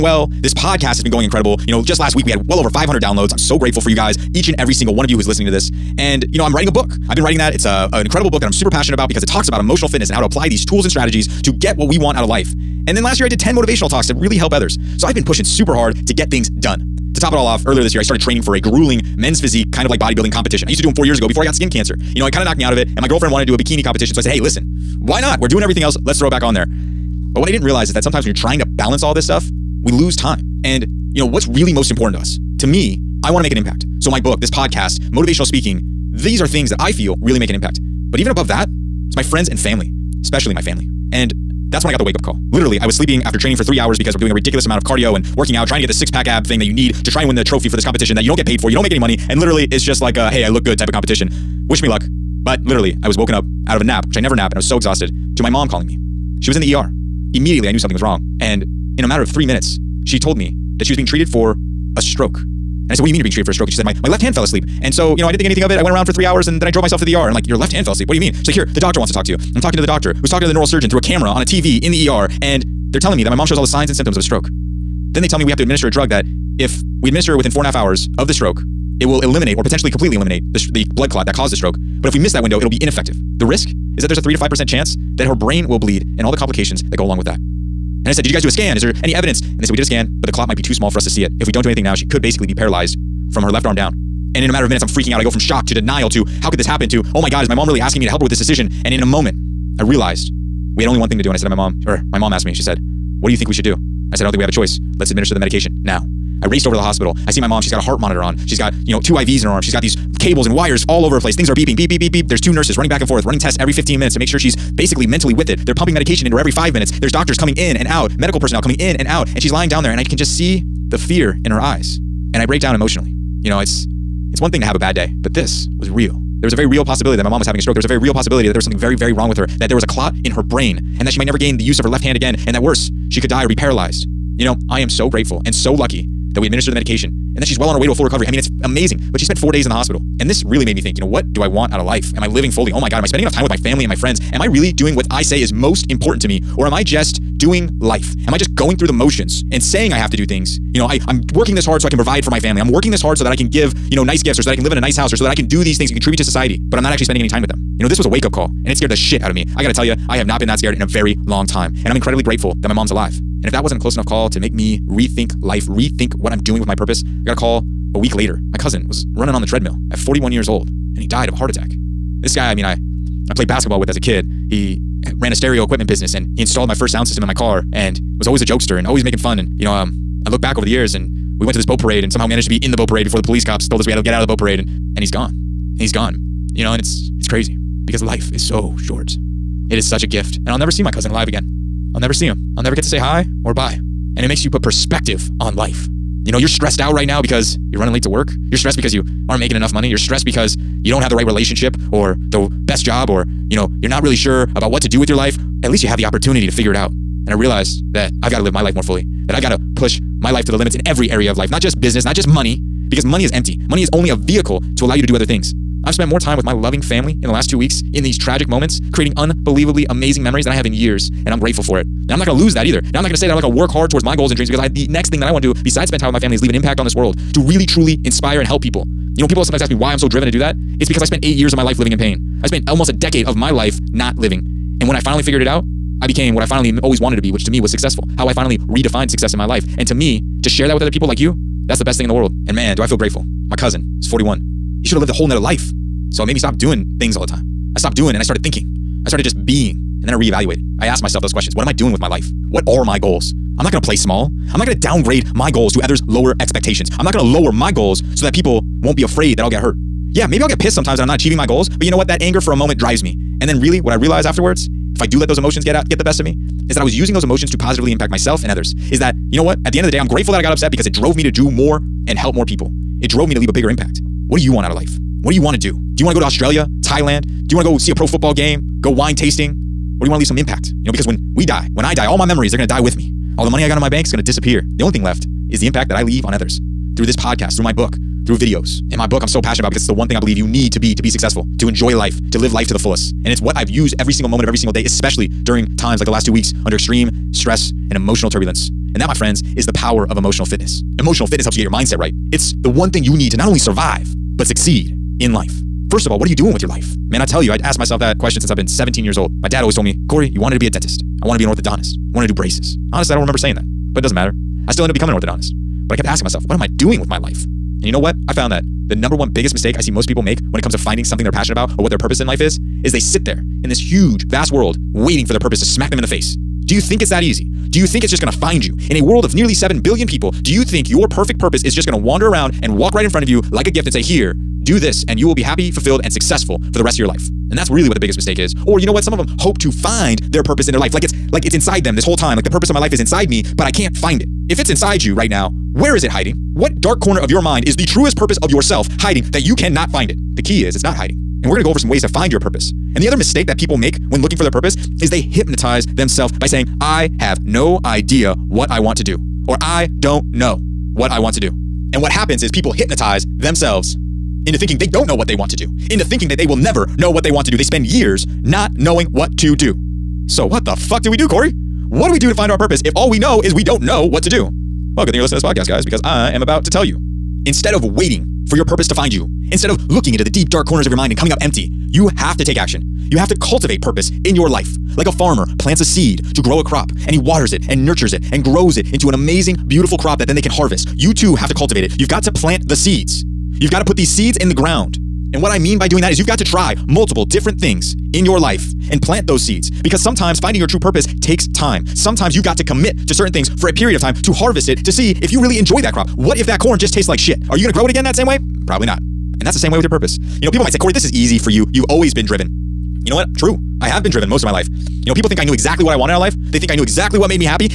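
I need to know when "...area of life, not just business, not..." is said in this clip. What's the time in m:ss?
3:31.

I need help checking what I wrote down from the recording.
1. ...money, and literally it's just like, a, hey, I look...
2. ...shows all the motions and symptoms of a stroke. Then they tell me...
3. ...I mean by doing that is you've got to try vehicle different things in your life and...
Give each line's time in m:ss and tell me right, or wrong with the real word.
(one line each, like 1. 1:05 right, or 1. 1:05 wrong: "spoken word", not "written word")
1. 0:48 right
2. 1:13 wrong: "signs", not "motions"
3. 6:35 wrong: "multiple", not "vehicle".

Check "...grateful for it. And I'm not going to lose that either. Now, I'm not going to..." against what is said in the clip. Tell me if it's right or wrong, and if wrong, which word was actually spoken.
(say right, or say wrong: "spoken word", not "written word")
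right.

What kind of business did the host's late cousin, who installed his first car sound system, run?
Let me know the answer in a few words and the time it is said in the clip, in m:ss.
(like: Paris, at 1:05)
Stereo equipment, at 2:55.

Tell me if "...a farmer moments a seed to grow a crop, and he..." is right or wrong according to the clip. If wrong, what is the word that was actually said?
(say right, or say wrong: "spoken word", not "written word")
wrong: "plants", not "moments".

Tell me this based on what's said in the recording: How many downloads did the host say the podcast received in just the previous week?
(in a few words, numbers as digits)
500.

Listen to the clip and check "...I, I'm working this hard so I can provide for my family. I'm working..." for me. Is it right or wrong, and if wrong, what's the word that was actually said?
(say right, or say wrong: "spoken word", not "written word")
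right.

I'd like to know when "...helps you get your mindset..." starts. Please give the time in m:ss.
5:01.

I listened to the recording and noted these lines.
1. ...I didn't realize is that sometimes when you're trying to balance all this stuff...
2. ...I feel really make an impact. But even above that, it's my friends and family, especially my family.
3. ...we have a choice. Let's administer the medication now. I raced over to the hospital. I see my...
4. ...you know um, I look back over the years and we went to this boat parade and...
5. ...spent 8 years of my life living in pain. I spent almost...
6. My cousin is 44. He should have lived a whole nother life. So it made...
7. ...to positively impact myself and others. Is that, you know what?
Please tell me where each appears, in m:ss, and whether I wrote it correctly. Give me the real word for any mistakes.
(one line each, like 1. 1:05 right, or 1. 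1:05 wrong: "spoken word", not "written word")
1. 0:27 right
2. 0:36 right
3. 1:44 right
4. 2:59 right
5. 3:51 right
6. 4:03 wrong: "41", not "44"
7. 4:27 right.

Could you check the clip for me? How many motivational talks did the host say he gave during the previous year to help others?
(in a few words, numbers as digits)
10.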